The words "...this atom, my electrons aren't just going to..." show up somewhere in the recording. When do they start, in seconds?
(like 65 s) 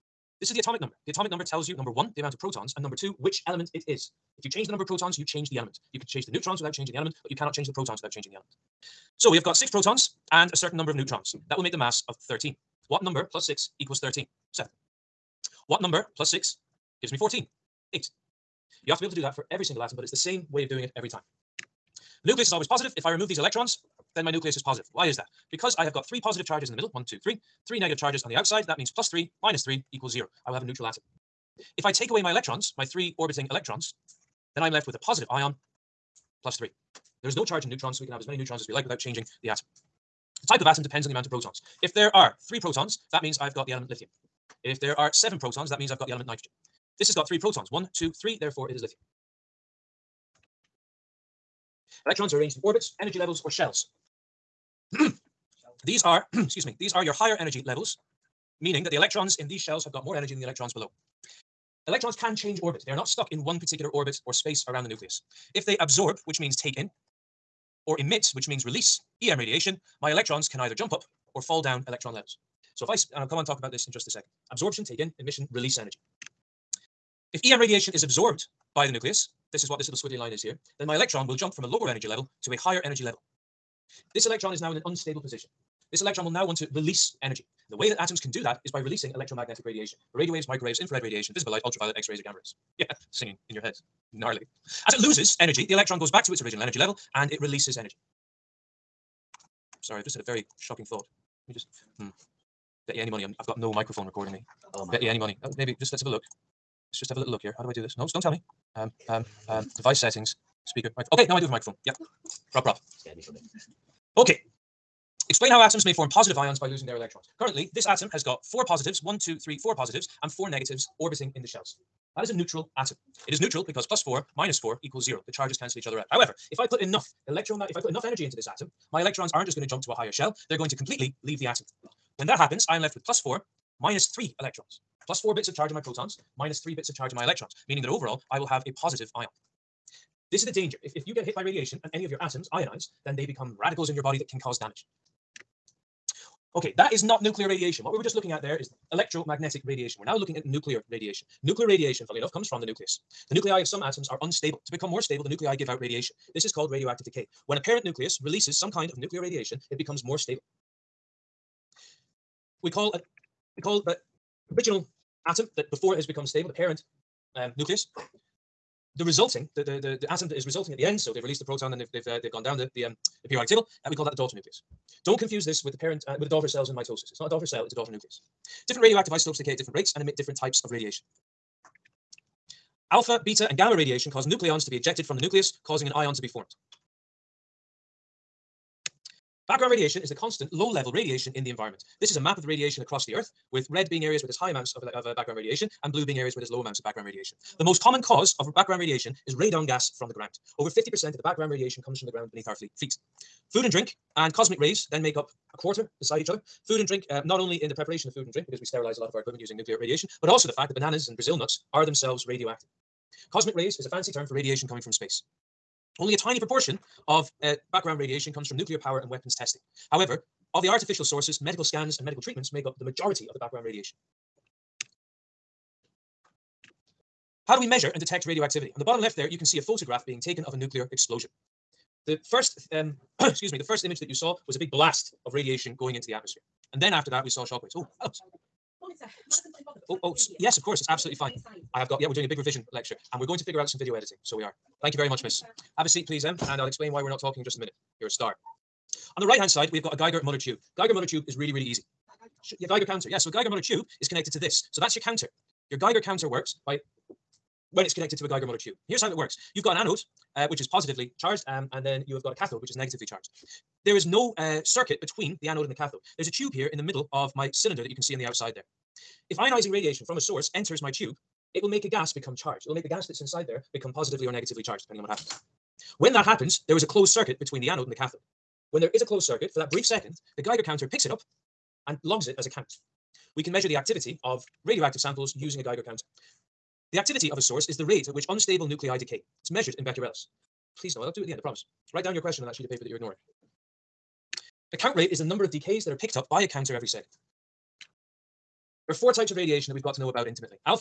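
128 s.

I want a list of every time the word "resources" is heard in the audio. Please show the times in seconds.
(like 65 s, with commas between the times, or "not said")
not said.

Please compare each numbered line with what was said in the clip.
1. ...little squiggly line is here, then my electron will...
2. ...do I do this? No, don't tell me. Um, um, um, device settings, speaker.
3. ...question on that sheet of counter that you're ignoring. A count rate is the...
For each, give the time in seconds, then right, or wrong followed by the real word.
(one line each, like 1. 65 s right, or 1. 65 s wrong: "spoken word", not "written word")
1. 79 s right
2. 107 s right
3. 292 s wrong: "paper", not "counter".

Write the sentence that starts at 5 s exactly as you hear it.
You can change the neutrons without changing the element, but you cannot change the protons without changing the element.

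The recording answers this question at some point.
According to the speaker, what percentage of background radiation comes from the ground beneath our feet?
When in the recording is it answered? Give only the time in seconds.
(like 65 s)
200 s.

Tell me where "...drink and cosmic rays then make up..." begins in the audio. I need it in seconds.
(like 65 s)
203 s.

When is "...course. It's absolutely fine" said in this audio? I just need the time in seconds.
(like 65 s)
240 s.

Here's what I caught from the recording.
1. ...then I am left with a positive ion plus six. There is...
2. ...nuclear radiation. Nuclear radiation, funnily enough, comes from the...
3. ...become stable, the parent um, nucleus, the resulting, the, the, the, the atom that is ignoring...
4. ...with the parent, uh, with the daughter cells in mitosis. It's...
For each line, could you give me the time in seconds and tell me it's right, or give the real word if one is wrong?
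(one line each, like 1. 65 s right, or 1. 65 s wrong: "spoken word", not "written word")
1. 34 s wrong: "three", not "six"
2. 150 s right
3. 166 s wrong: "resulting", not "ignoring"
4. 175 s right.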